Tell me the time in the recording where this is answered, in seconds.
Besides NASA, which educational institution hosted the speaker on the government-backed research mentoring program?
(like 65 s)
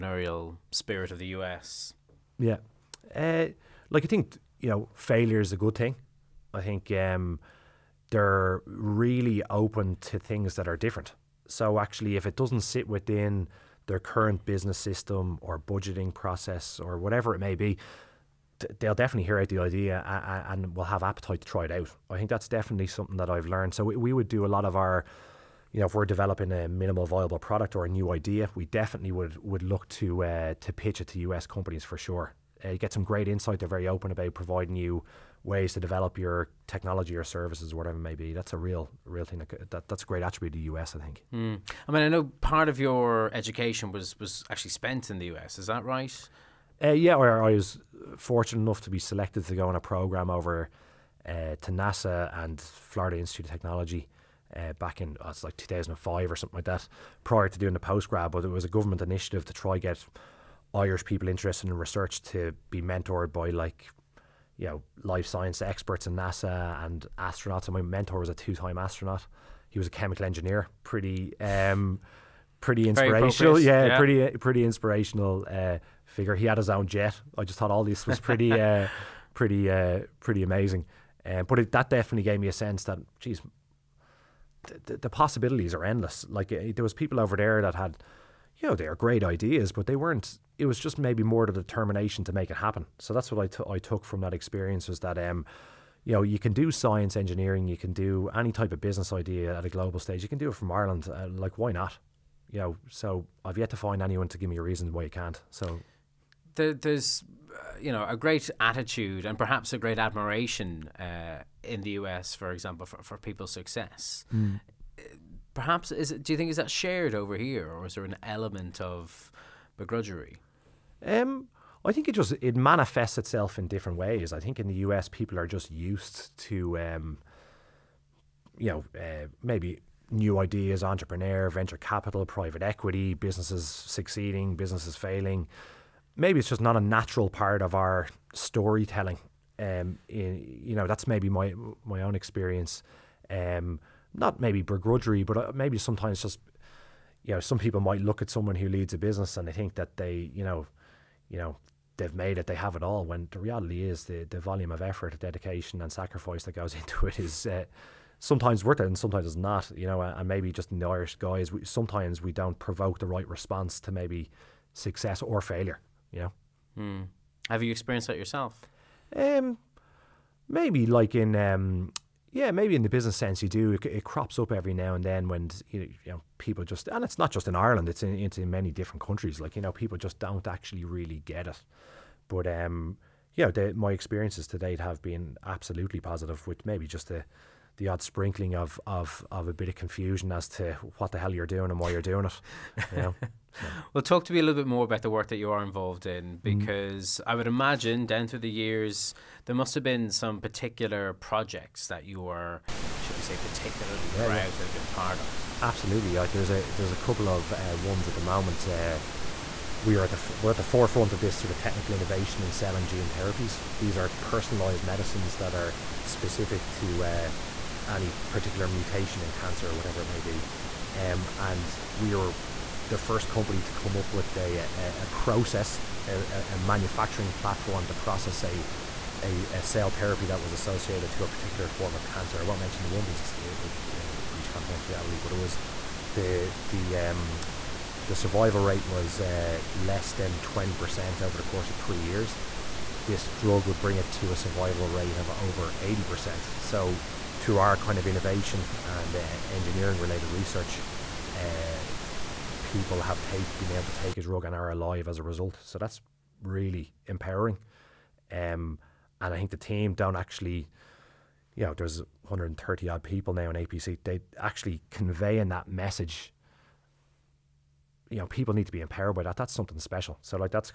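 52 s.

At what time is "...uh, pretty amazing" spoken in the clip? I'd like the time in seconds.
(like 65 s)
79 s.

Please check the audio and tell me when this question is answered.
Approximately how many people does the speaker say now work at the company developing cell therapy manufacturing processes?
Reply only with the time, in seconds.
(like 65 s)
262 s.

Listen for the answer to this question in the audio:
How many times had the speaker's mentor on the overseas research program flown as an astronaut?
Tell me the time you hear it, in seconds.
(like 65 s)
68 s.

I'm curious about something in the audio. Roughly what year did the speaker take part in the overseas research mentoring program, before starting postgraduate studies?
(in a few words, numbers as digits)
2005.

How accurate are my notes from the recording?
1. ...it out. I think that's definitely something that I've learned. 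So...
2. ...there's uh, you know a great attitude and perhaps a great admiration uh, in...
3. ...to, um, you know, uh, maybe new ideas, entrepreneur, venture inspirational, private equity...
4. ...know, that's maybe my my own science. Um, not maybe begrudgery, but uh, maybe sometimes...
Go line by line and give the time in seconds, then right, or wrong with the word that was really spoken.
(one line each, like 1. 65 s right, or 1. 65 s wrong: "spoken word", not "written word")
1. 21 s right
2. 106 s right
3. 126 s wrong: "capital", not "inspirational"
4. 140 s wrong: "experience", not "science".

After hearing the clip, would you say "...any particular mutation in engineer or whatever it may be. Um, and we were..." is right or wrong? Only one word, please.
wrong.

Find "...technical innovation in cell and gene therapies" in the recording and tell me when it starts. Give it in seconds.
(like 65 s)
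211 s.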